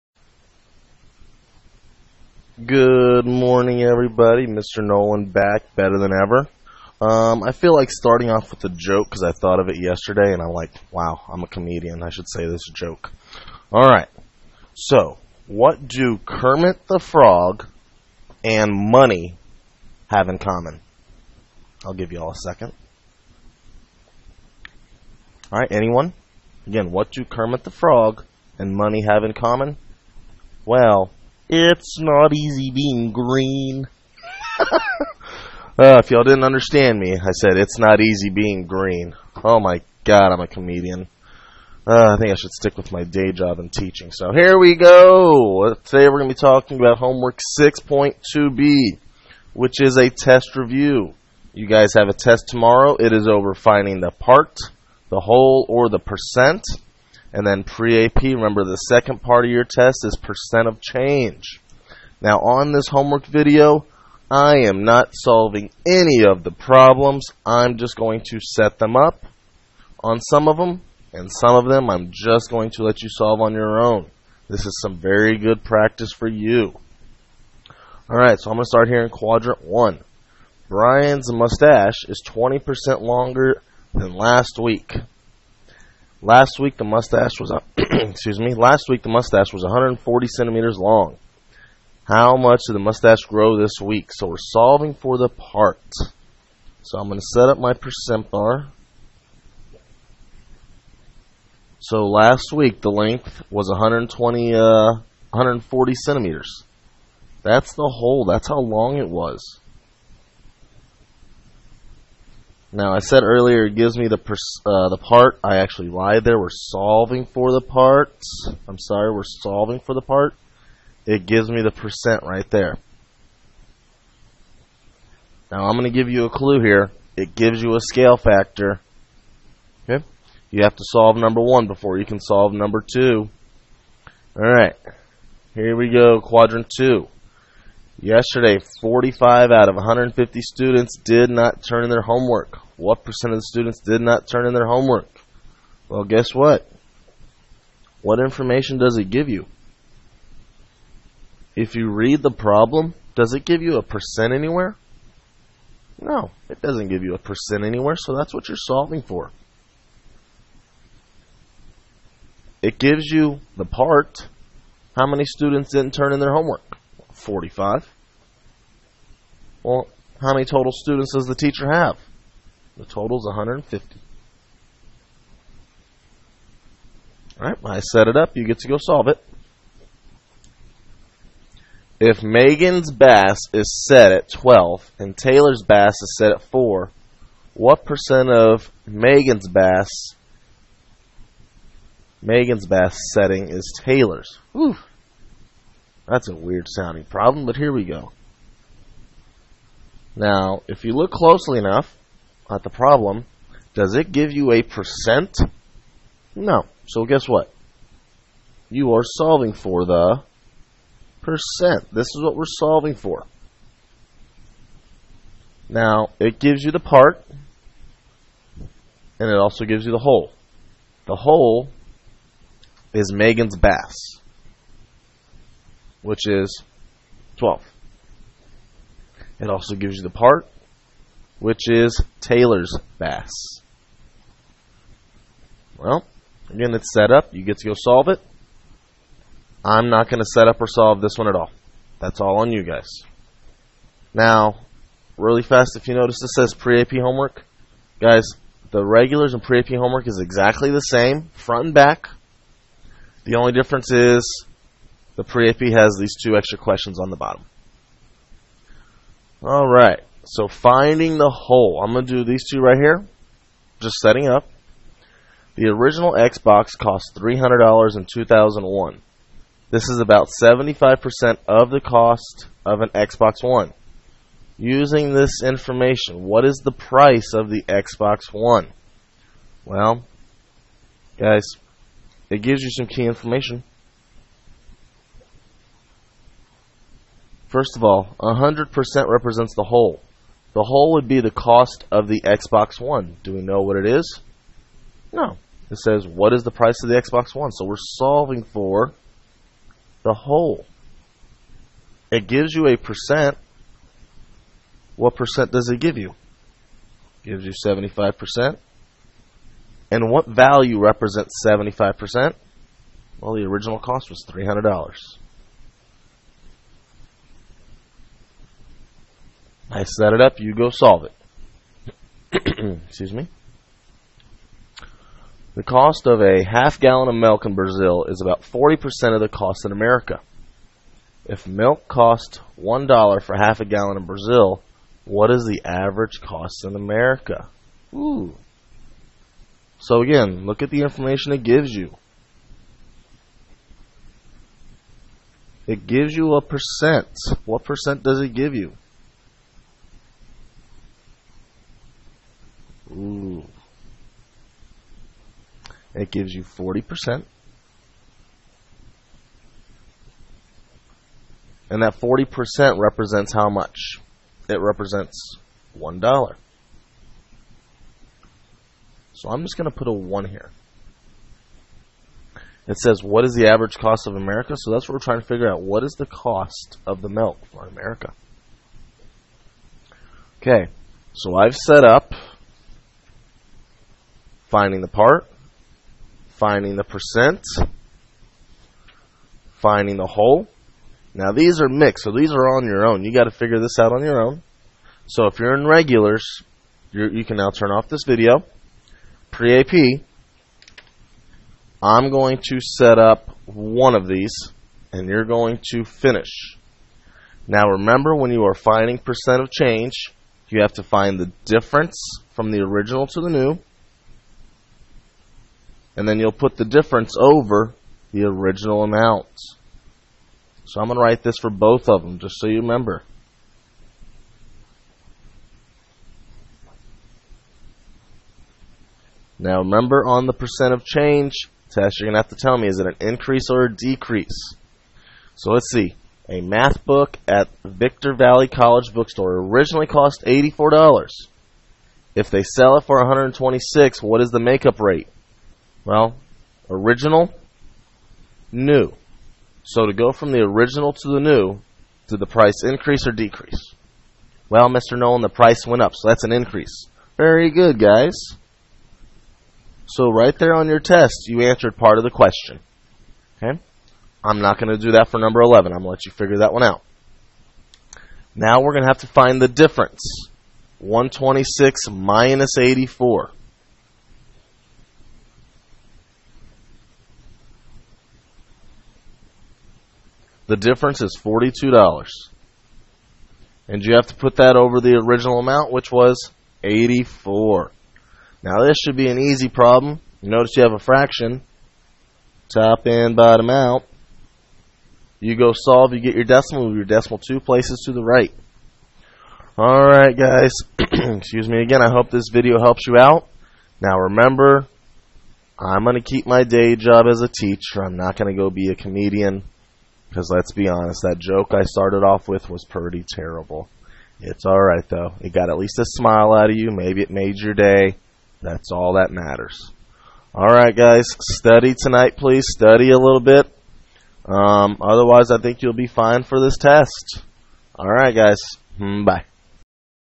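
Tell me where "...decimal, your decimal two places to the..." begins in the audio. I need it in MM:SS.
08:16.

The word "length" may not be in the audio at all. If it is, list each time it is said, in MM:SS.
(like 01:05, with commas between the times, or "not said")
01:42.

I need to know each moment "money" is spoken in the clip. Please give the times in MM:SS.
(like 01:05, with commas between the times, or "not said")
00:18, 00:28.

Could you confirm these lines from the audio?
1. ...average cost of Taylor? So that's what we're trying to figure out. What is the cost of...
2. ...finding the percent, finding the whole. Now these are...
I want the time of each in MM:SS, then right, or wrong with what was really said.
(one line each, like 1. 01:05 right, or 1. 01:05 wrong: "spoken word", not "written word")
1. 06:13 wrong: "America", not "Taylor"
2. 06:26 right.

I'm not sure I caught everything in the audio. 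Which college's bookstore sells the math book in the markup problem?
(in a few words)
Victor Valley College.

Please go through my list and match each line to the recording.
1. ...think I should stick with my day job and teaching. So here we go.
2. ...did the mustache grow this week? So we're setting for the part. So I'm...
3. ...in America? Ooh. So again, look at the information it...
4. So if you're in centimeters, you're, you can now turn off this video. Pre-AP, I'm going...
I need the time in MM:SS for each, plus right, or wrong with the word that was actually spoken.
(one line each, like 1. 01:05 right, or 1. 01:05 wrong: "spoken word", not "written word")
1. 00:42 right
2. 01:32 wrong: "solving", not "setting"
3. 05:36 right
4. 06:35 wrong: "regulars", not "centimeters".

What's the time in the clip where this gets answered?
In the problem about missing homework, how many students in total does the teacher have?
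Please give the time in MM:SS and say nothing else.
02:52.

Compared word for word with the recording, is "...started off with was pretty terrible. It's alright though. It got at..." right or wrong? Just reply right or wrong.
right.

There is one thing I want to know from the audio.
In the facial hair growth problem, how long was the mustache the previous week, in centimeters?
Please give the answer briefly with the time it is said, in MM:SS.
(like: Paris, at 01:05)
140, at 01:29.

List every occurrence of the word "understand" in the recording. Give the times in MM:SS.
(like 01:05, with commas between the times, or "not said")
00:36.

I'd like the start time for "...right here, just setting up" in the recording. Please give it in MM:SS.
04:22.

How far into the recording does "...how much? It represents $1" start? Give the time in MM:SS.
06:03.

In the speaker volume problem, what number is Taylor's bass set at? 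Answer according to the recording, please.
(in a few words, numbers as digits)
4.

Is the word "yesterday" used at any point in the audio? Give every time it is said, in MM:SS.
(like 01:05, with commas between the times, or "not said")
00:09, 02:18.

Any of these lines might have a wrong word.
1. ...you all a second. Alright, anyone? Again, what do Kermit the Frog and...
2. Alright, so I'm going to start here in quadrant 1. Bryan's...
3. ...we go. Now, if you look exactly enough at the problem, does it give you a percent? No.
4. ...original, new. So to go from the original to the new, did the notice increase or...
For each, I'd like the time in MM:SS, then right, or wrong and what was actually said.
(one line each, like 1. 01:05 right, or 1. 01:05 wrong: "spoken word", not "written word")
1. 00:22 right
2. 01:18 right
3. 03:17 wrong: "closely", not "exactly"
4. 07:26 wrong: "price", not "notice".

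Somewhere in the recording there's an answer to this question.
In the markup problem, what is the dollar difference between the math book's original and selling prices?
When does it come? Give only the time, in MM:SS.
08:01.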